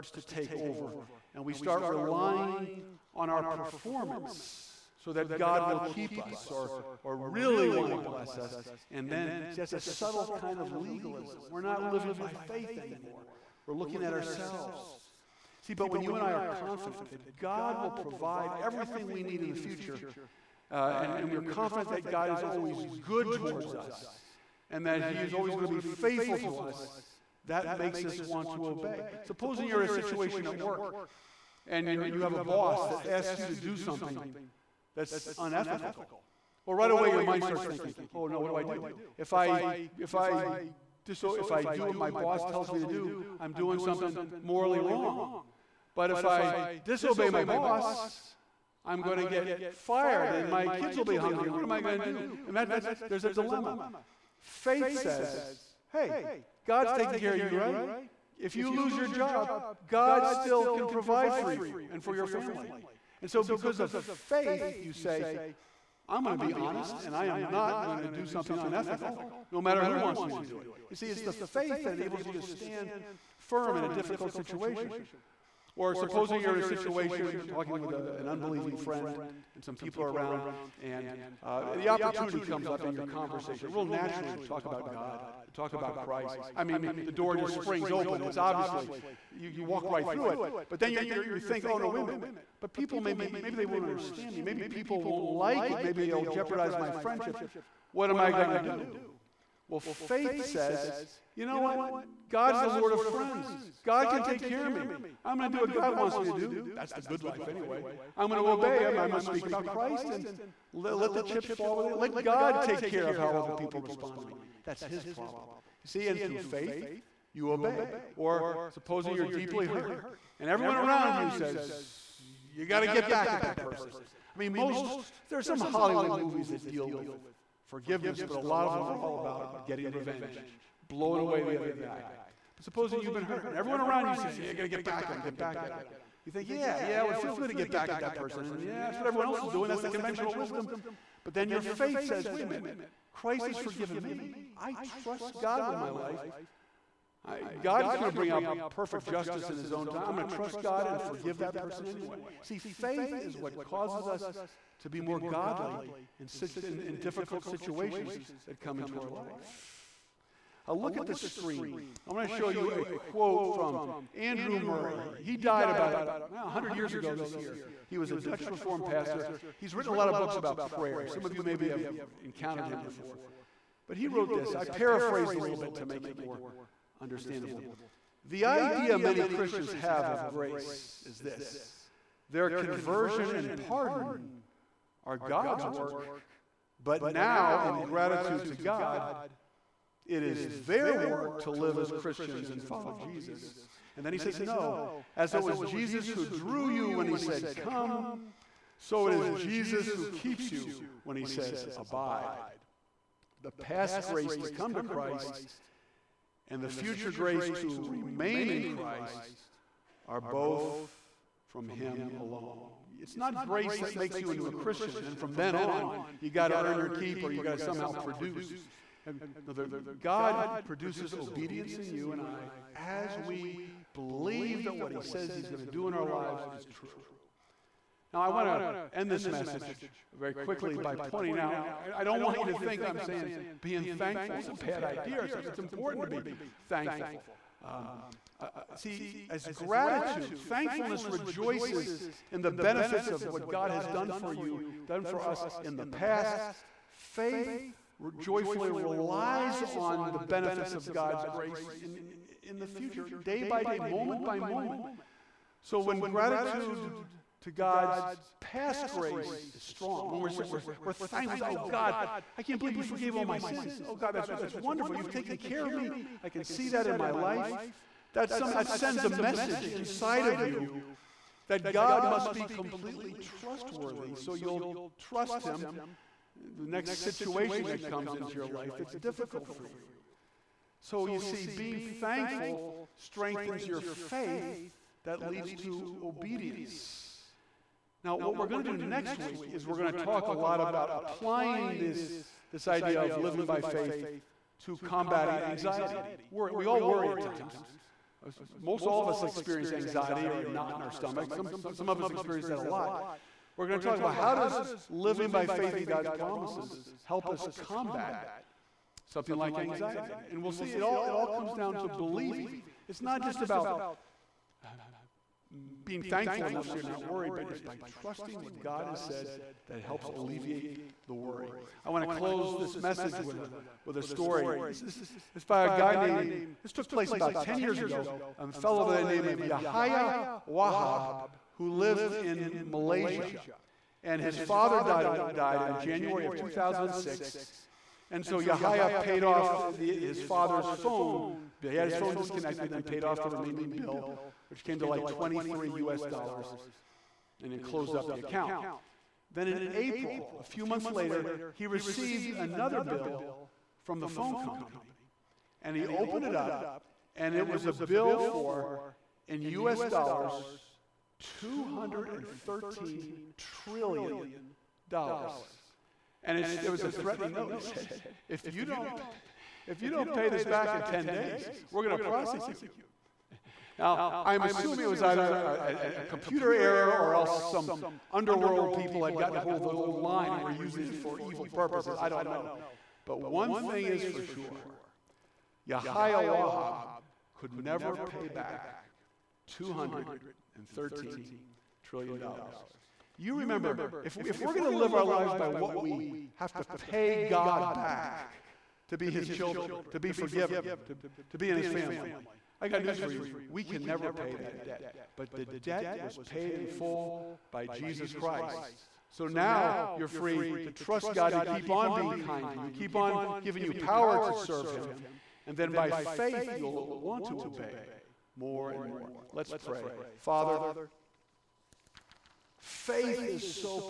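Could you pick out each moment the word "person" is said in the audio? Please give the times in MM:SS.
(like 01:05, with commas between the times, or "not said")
02:03, 02:18, 02:31.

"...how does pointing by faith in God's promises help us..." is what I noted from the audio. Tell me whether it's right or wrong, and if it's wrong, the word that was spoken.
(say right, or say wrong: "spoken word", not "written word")
wrong: "living", not "pointing".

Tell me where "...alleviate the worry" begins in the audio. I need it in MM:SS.
05:20.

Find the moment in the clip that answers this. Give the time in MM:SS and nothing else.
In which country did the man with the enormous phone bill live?
05:32.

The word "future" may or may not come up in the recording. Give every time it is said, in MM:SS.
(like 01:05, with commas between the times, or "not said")
00:19, 03:26, 04:12.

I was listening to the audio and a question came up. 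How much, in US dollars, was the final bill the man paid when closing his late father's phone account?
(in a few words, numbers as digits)
$23.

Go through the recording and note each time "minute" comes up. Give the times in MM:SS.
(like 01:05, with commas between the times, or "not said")
01:32, 02:22.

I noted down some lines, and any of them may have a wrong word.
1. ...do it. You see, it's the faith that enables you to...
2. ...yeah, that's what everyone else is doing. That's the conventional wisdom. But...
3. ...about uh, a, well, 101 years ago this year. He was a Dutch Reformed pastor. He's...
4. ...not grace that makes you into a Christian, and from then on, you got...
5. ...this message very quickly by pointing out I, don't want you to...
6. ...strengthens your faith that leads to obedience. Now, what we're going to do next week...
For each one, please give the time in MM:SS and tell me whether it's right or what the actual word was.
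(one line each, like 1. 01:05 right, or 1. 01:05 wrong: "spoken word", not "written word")
1. 01:10 right
2. 02:18 right
3. 02:45 wrong: "100", not "101"
4. 03:33 right
5. 03:49 right
6. 04:42 right.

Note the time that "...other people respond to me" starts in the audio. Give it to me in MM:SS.
01:53.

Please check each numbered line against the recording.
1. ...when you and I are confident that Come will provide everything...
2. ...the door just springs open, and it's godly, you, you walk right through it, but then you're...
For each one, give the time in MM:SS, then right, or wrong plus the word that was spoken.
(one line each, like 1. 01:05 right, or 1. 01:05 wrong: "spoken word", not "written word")
1. 00:15 wrong: "God", not "Come"
2. 01:27 wrong: "obviously", not "godly".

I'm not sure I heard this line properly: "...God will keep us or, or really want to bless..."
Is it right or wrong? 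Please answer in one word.
right.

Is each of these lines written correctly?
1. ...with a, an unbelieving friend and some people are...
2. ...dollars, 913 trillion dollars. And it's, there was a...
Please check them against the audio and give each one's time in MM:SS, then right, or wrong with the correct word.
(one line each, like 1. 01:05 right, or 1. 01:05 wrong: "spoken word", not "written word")
1. 01:17 right
2. 05:59 wrong: "213", not "913".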